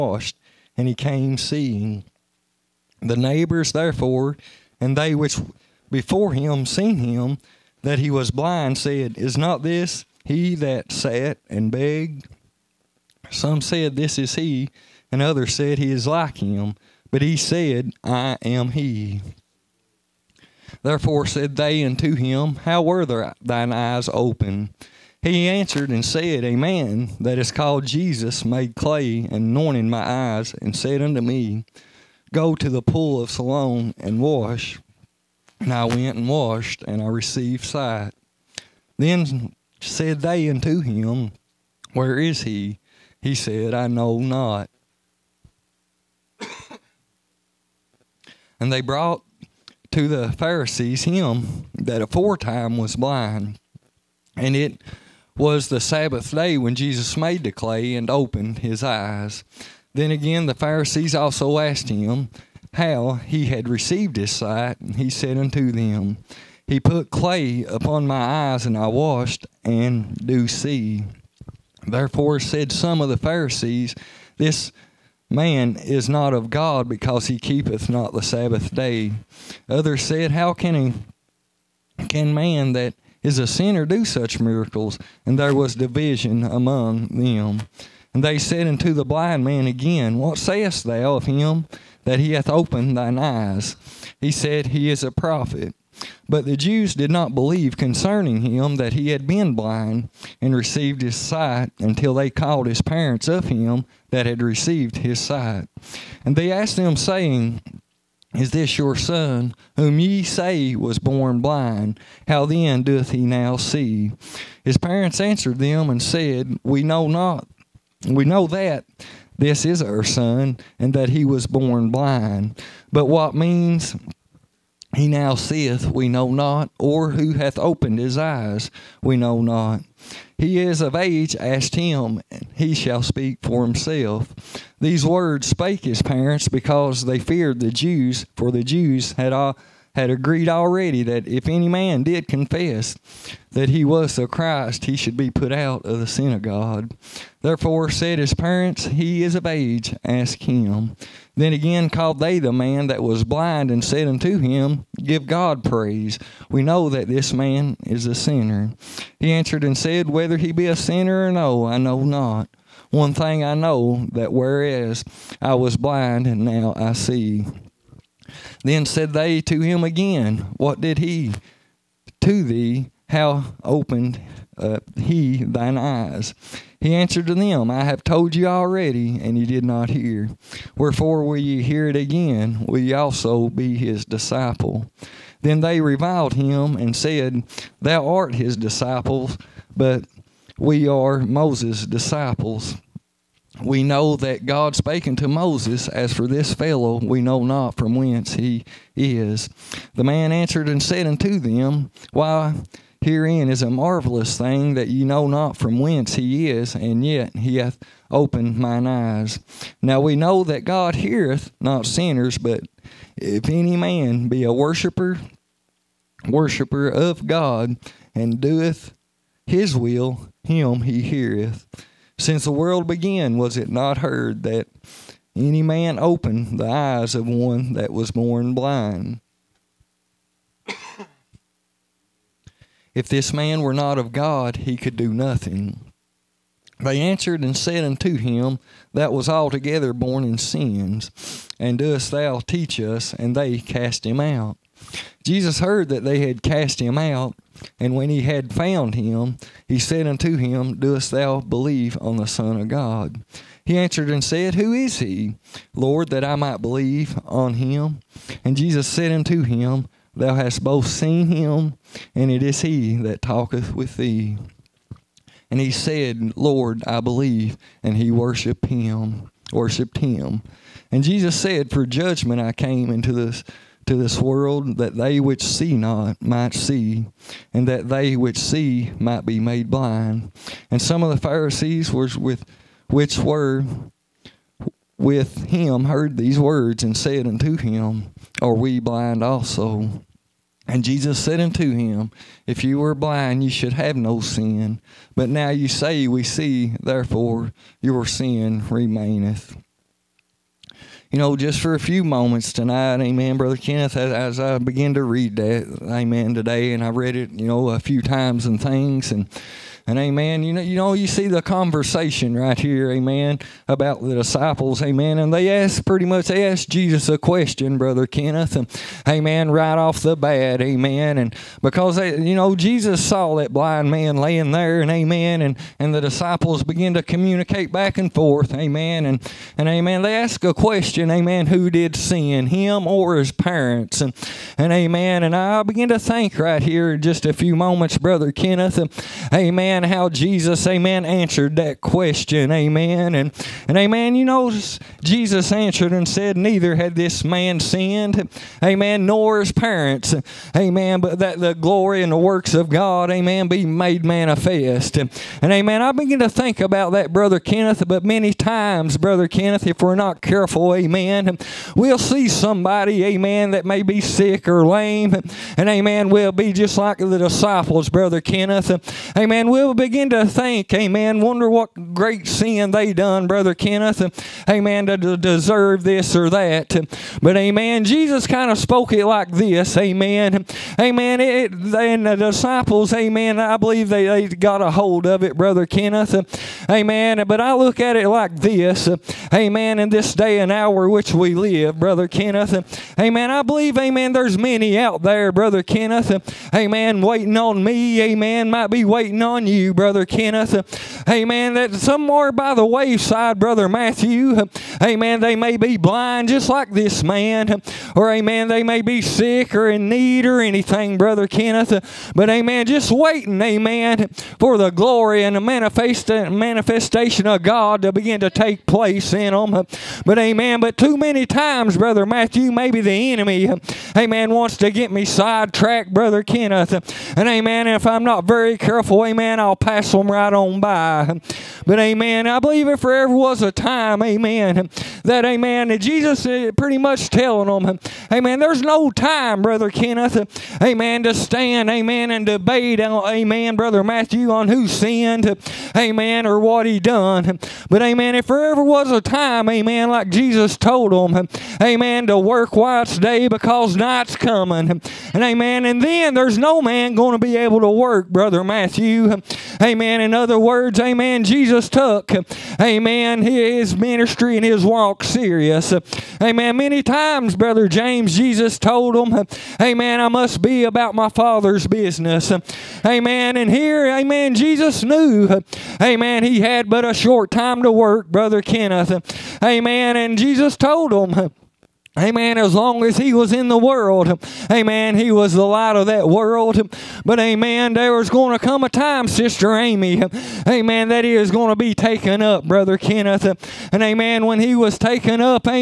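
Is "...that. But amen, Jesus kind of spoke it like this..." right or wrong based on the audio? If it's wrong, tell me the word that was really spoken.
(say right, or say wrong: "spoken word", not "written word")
right.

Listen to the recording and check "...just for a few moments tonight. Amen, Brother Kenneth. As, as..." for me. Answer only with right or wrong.
right.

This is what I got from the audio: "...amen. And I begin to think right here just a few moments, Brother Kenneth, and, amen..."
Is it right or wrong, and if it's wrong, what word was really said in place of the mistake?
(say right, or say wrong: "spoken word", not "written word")
right.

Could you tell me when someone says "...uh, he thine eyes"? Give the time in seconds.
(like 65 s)
174 s.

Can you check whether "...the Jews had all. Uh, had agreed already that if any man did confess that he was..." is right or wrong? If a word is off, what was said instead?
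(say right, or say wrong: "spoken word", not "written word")
right.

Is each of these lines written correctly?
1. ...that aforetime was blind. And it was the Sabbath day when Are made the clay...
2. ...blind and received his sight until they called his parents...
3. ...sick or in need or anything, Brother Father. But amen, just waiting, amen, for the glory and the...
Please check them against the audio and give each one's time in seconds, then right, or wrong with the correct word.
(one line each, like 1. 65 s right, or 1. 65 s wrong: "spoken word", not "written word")
1. 51 s wrong: "Jesus", not "Are"
2. 99 s right
3. 409 s wrong: "Kenneth", not "Father".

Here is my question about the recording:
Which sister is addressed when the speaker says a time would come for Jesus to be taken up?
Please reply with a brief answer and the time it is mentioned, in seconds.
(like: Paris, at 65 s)
Sister Amy, at 489 s.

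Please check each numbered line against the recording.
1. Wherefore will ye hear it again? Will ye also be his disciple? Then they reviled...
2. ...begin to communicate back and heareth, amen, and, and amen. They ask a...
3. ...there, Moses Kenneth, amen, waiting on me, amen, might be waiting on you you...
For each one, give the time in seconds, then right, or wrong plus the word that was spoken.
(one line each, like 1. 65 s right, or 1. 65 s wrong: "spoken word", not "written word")
1. 180 s right
2. 326 s wrong: "forth", not "heareth"
3. 395 s wrong: "Brother", not "Moses".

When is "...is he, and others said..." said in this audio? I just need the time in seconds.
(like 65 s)
14 s.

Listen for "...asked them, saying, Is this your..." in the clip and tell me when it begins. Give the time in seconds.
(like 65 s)
106 s.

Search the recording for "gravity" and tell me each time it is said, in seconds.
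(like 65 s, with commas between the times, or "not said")
not said.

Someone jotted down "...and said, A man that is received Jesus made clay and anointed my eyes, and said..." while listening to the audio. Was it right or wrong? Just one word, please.
wrong.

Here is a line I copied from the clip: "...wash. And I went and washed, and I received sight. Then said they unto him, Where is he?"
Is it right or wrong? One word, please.
right.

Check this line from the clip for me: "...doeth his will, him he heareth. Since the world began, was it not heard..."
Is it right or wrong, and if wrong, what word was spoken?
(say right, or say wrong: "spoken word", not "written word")
right.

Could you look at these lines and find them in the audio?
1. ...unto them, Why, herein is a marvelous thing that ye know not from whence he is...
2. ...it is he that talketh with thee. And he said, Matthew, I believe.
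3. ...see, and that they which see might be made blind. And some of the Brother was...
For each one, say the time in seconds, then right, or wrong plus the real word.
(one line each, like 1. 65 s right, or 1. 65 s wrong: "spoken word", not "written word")
1. 201 s right
2. 262 s wrong: "Lord", not "Matthew"
3. 276 s wrong: "Pharisees", not "Brother".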